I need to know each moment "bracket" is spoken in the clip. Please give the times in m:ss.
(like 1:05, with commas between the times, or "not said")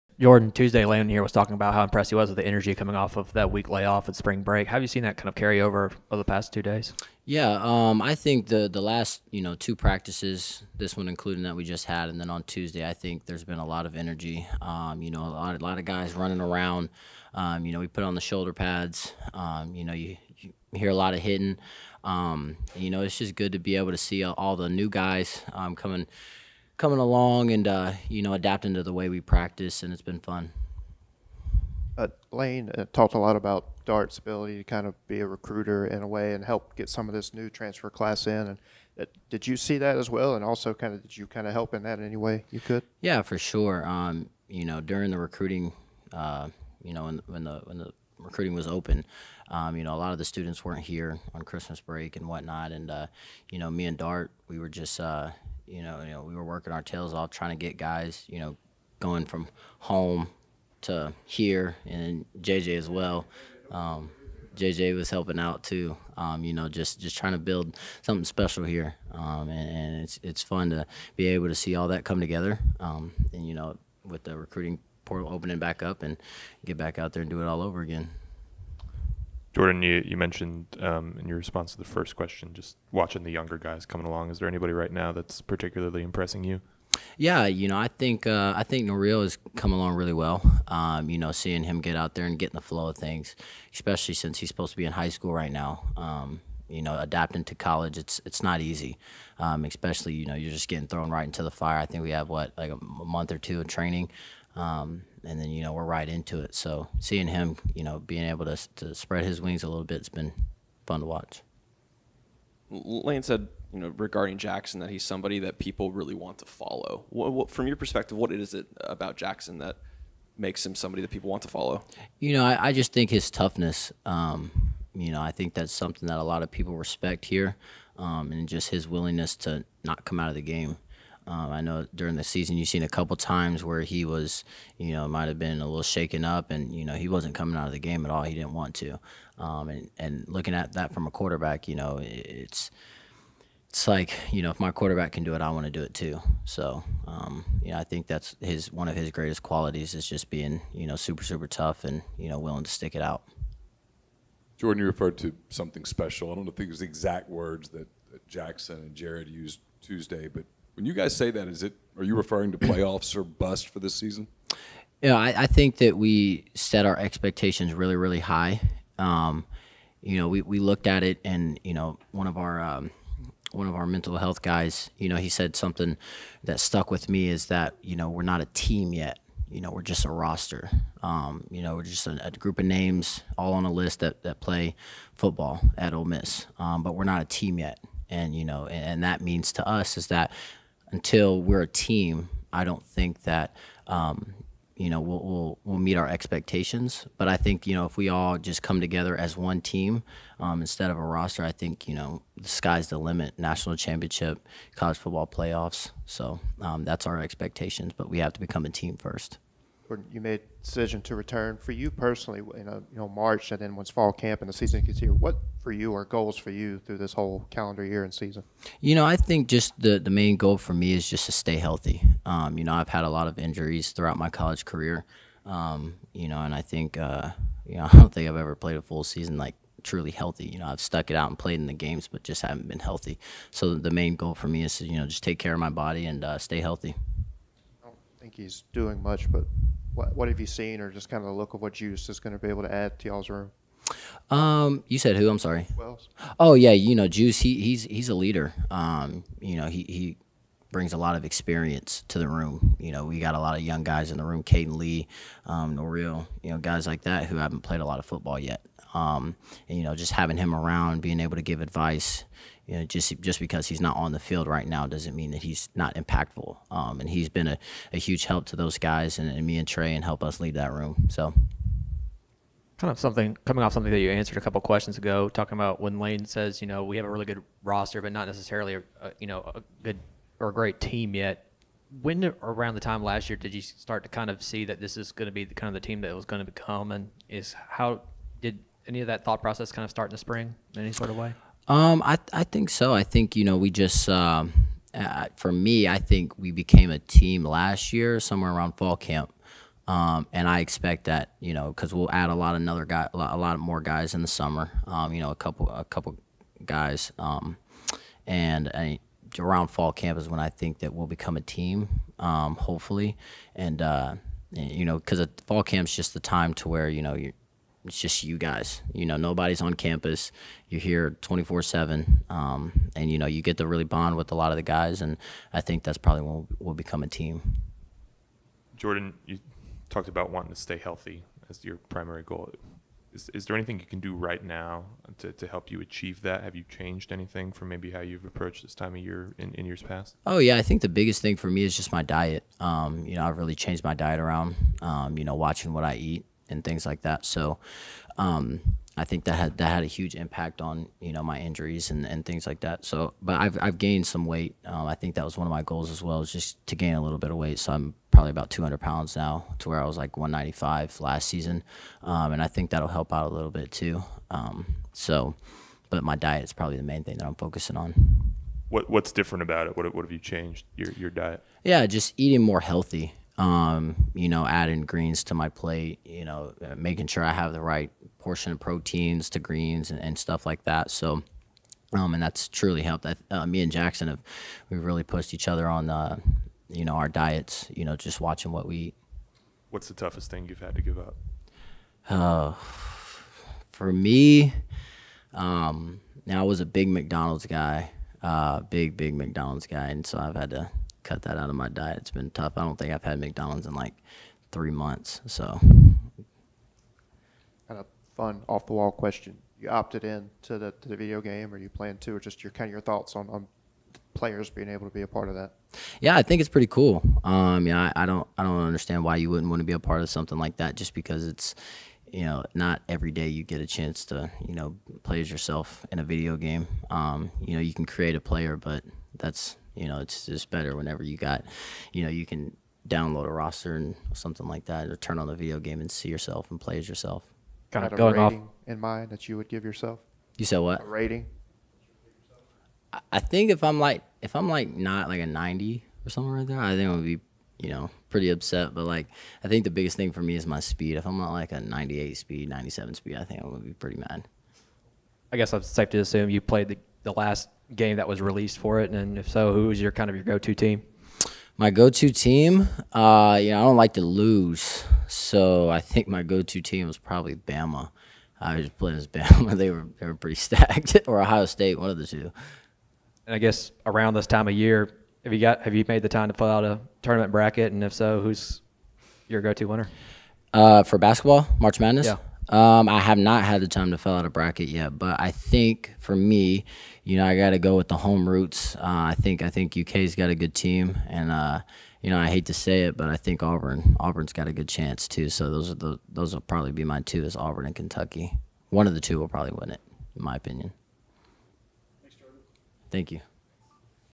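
7:57, 8:04.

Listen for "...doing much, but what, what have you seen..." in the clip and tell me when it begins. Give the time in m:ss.
3:58.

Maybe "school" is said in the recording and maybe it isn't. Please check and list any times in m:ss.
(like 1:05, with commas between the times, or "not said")
1:35.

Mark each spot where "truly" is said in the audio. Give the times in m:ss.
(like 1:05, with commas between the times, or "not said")
3:49, 6:22.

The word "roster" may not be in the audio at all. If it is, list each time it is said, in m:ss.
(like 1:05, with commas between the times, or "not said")
3:00, 3:21, 4:37, 7:13.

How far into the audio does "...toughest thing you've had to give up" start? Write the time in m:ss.
6:29.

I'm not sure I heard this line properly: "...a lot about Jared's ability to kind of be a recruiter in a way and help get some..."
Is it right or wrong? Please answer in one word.
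wrong.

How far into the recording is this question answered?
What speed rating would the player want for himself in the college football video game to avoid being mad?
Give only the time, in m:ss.
7:31.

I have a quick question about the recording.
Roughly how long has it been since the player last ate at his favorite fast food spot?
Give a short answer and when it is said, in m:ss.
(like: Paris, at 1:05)
three months, at 6:44.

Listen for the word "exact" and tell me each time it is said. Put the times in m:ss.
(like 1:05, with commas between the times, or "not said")
2:36.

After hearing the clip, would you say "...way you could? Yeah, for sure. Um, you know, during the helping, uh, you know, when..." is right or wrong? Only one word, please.
wrong.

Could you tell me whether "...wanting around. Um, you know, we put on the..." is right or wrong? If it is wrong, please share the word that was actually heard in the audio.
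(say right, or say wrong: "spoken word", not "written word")
wrong: "running", not "wanting".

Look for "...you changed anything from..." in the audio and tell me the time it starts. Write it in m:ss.
5:36.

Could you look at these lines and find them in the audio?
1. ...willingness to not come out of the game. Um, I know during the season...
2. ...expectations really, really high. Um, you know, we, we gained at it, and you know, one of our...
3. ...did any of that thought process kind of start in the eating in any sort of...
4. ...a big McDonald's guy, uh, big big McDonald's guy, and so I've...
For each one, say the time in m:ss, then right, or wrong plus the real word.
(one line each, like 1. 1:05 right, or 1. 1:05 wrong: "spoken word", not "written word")
1. 2:08 right
2. 2:46 wrong: "looked", not "gained"
3. 4:48 wrong: "spring", not "eating"
4. 6:36 right.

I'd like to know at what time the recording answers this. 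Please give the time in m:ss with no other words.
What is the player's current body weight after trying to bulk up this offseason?
5:58.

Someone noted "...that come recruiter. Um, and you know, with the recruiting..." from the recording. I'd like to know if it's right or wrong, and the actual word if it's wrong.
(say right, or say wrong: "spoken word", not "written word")
wrong: "together", not "recruiter".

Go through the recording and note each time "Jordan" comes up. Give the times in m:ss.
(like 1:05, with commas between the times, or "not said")
0:00, 1:19, 2:34, 5:28.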